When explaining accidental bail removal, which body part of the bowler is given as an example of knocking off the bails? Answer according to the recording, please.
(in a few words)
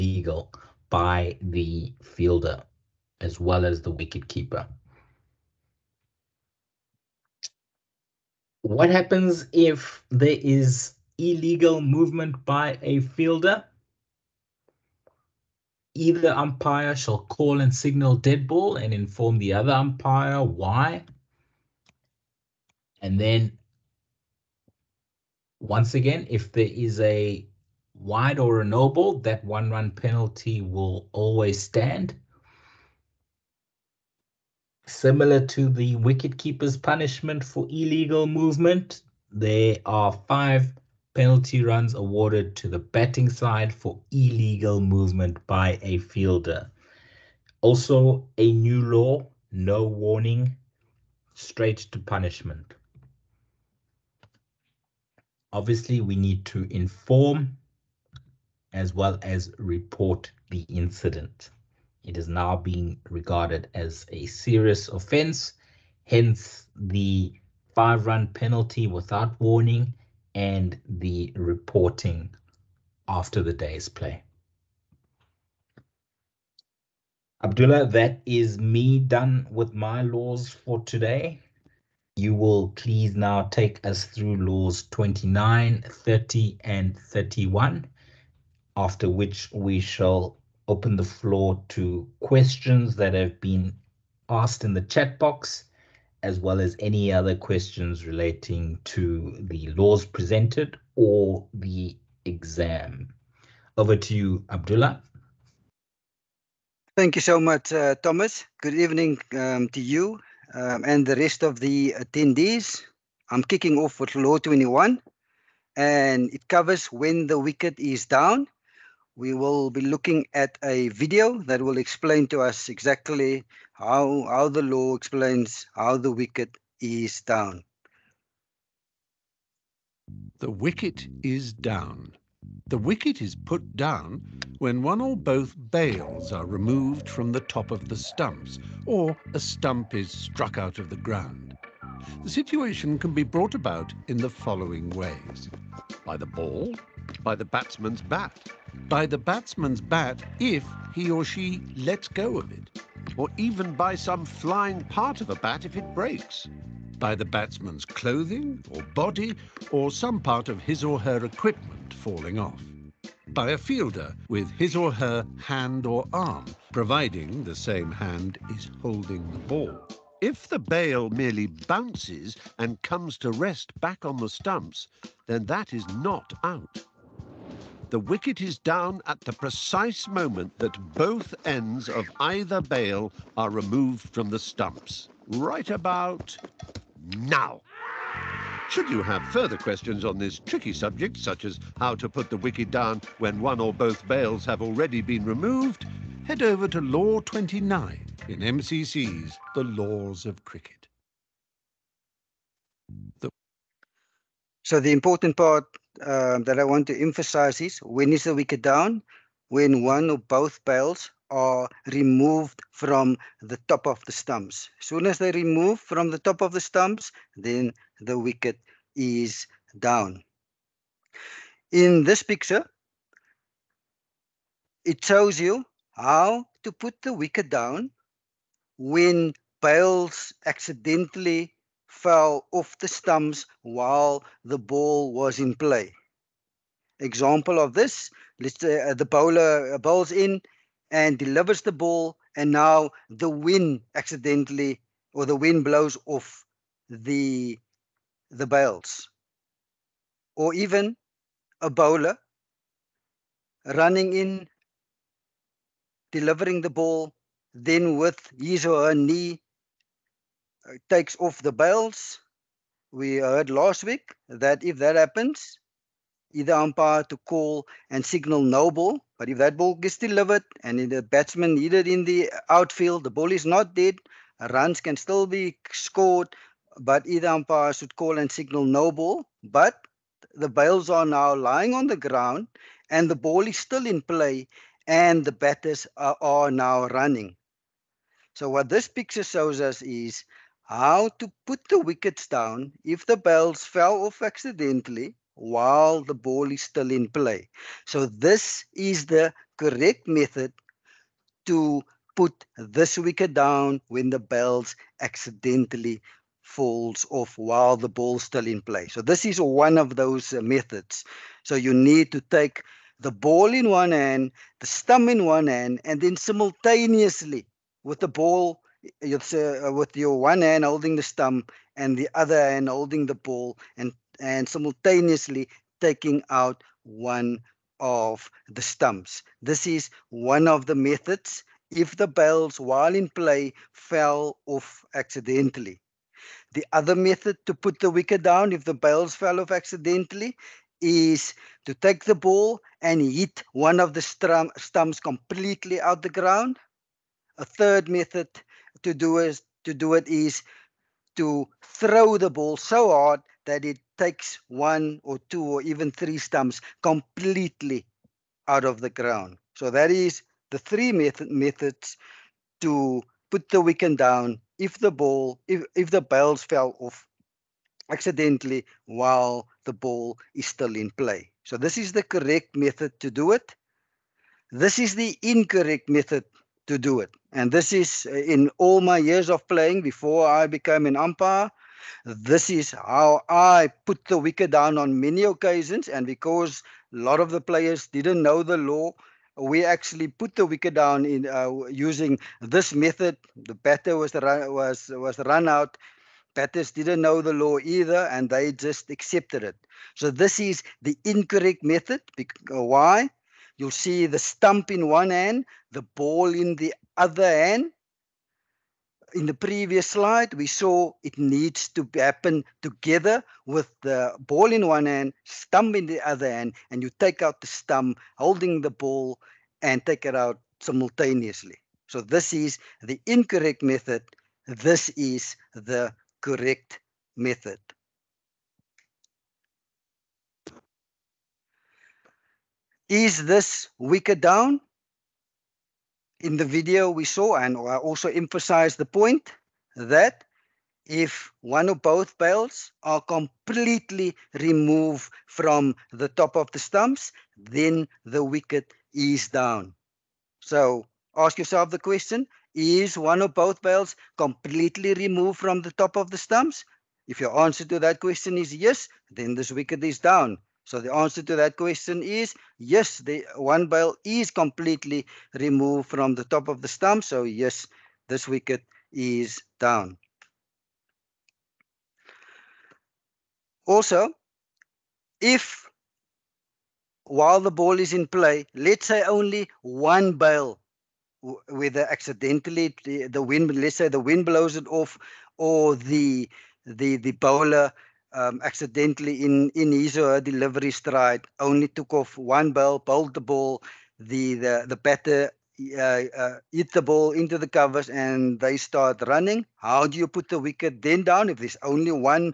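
knee.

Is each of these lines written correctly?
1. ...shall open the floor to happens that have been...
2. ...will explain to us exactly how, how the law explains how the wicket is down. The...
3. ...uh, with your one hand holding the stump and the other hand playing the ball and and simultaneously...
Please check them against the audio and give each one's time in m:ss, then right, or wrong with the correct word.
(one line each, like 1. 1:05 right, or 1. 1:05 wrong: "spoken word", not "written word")
1. 1:29 wrong: "questions", not "happens"
2. 2:01 right
3. 5:19 wrong: "holding", not "playing".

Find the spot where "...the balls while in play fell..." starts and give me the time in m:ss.
5:31.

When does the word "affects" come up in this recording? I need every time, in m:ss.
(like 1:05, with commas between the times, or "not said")
not said.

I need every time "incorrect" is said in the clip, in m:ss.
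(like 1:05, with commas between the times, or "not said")
6:15, 6:41, 7:03.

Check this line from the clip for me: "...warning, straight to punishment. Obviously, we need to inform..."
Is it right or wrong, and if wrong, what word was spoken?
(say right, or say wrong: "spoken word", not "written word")
right.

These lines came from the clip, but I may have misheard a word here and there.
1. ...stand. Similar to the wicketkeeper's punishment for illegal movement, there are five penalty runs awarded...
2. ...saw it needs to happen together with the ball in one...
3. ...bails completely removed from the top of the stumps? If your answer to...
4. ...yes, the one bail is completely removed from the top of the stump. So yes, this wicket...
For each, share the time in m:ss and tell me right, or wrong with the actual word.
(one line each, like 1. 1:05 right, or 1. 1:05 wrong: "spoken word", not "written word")
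1. 0:31 right
2. 6:50 right
3. 7:33 right
4. 7:42 right.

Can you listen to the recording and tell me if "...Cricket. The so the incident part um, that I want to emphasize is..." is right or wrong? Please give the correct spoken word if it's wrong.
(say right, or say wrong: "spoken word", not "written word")
wrong: "important", not "incident".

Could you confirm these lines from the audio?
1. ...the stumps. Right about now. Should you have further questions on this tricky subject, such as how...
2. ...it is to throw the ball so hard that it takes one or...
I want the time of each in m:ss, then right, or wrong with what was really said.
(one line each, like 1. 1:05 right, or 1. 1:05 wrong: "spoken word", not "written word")
1. 3:04 right
2. 5:49 right.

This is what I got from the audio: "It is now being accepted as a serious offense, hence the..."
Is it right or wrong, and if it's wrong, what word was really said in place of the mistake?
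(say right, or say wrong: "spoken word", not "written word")
wrong: "regarded", not "accepted".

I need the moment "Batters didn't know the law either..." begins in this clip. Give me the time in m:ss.
6:36.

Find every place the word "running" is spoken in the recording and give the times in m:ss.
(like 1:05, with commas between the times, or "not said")
4:13, 4:46, 8:19.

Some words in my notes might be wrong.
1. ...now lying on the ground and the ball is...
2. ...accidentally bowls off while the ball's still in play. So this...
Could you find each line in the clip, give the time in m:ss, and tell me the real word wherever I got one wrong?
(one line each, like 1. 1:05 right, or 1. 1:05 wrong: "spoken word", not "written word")
1. 4:41 right
2. 5:05 wrong: "falls", not "bowls".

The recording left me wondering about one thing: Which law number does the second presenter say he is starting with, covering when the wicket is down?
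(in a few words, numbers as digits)
Law 21.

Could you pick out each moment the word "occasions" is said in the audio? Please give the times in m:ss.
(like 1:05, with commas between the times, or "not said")
6:25.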